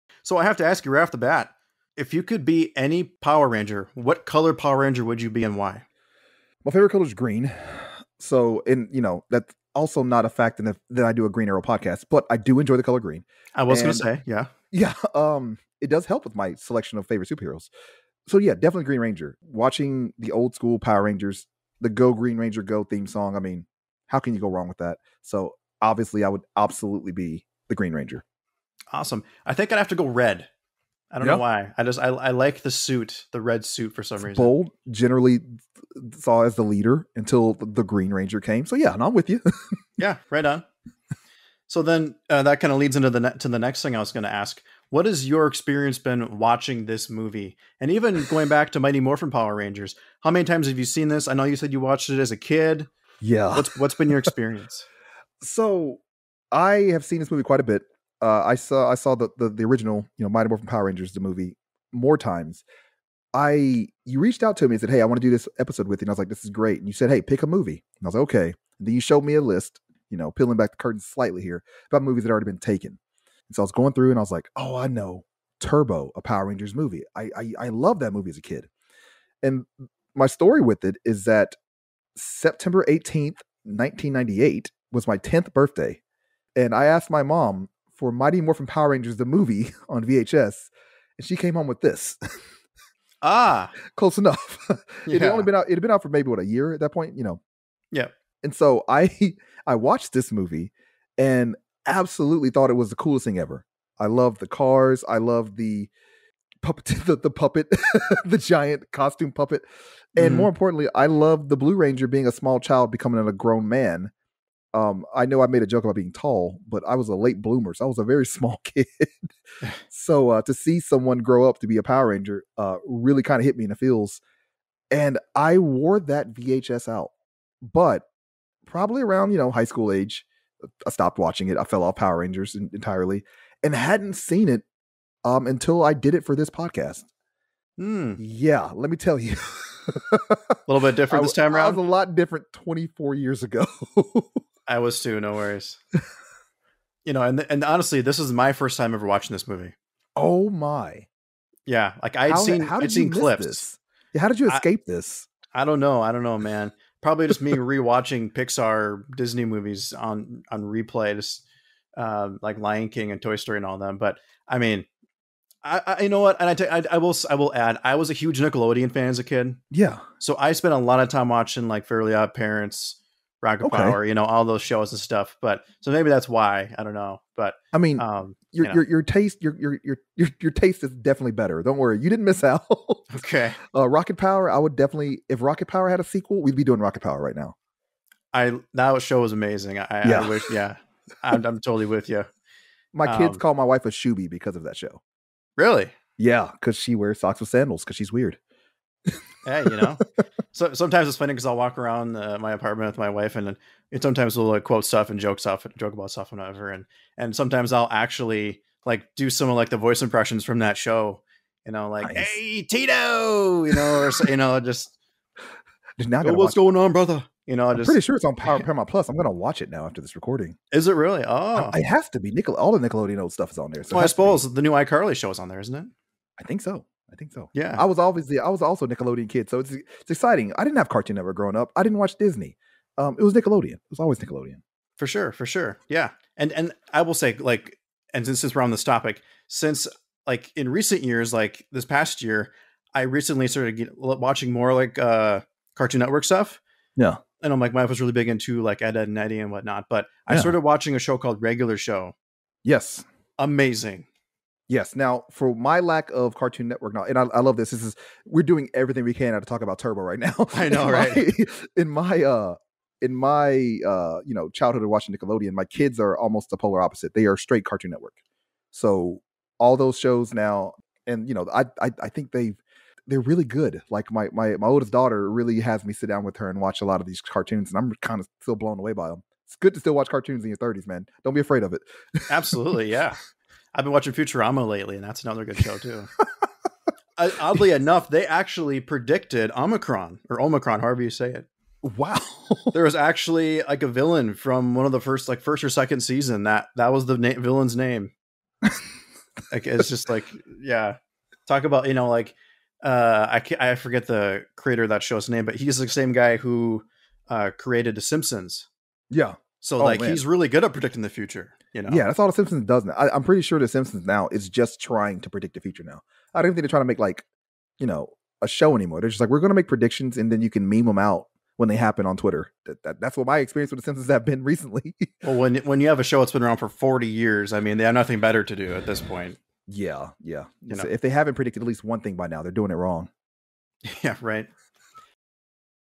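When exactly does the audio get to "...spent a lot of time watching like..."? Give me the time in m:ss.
2:50.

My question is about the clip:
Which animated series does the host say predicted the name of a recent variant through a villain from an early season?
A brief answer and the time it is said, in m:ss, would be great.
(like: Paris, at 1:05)
Futurama, at 4:44.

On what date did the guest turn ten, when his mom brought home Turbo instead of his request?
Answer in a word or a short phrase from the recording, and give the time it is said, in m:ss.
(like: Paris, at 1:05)
September 18, 1998, at 1:22.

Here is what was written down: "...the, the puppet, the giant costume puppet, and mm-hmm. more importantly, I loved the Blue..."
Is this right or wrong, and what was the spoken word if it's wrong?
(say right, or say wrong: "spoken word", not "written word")
right.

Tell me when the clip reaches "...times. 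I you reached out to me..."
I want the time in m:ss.
1:02.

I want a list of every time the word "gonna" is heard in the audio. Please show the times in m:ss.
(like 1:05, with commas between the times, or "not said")
3:39, 5:19.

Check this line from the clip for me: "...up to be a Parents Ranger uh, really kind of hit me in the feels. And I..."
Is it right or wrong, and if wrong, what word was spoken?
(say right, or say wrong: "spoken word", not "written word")
wrong: "Power", not "Parents".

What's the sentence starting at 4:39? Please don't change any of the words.
It's good to still watch cartoons in your 30s, man.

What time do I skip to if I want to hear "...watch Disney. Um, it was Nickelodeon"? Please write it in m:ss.
3:51.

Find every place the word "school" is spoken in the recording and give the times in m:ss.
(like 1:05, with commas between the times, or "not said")
0:20, 2:09.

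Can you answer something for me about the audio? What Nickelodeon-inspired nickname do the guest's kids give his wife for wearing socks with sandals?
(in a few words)
Shoobie.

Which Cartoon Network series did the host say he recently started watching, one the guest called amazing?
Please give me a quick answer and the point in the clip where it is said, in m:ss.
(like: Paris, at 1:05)
Regular Show, at 4:11.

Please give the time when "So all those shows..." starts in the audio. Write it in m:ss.
4:28.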